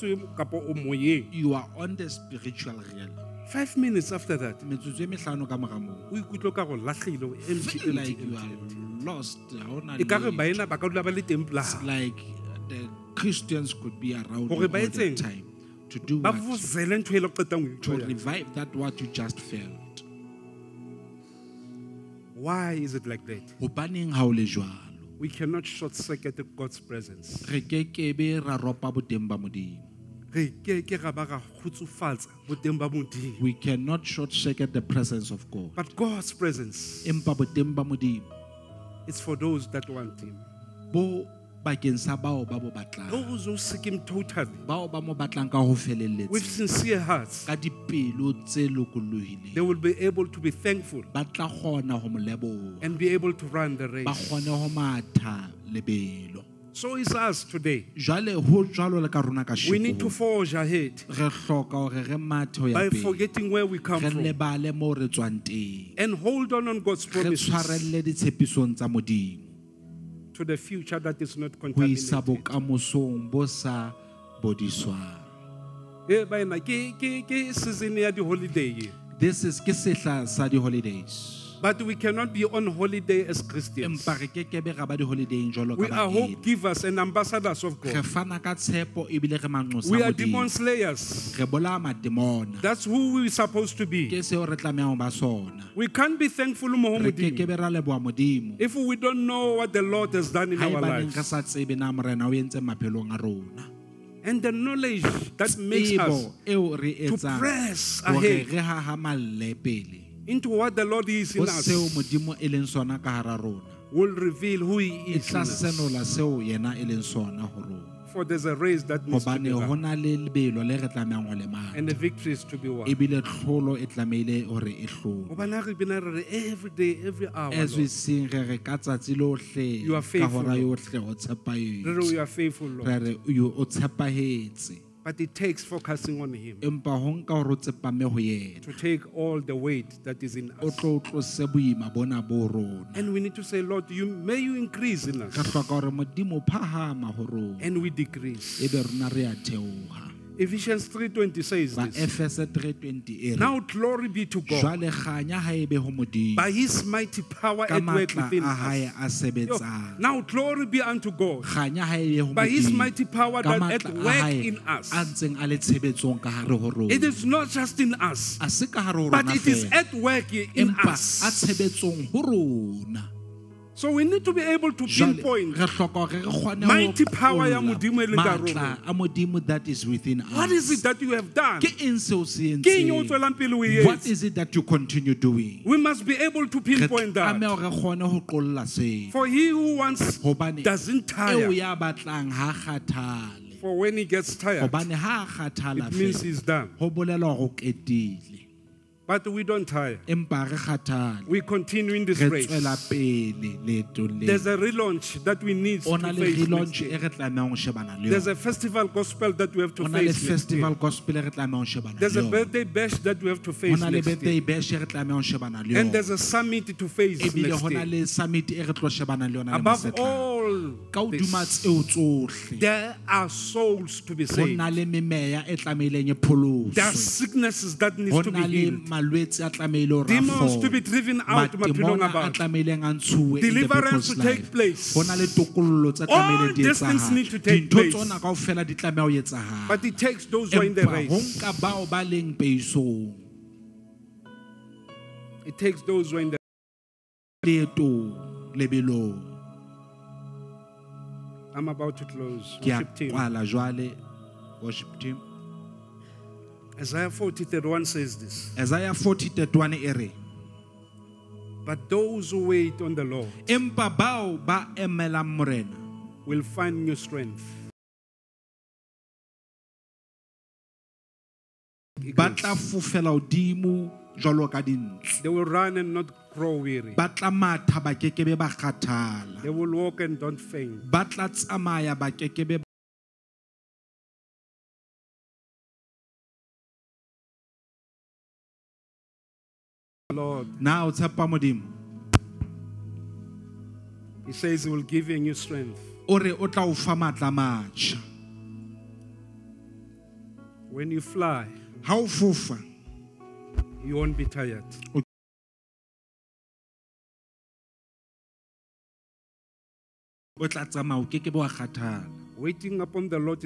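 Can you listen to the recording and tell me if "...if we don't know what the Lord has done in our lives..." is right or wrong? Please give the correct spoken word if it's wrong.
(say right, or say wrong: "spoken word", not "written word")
right.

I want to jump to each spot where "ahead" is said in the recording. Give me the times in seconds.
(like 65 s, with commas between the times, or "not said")
60 s, 108 s.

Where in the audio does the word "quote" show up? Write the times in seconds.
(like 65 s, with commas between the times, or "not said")
not said.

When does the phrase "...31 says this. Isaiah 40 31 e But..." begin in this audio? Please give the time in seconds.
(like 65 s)
257 s.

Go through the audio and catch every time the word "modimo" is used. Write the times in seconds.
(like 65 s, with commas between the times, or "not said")
155 s, 177 s.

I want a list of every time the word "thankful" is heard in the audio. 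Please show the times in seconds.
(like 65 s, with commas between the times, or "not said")
50 s, 96 s.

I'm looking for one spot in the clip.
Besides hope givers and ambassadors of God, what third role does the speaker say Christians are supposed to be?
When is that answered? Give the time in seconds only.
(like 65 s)
90 s.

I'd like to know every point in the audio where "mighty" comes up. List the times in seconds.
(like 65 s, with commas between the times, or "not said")
156 s, 162 s, 176 s.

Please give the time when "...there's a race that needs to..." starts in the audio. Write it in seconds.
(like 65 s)
118 s.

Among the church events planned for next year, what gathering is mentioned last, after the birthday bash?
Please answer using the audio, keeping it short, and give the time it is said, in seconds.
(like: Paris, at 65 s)
A summit, at 216 s.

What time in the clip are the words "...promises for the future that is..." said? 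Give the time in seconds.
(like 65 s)
67 s.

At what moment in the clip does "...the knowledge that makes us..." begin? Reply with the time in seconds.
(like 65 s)
104 s.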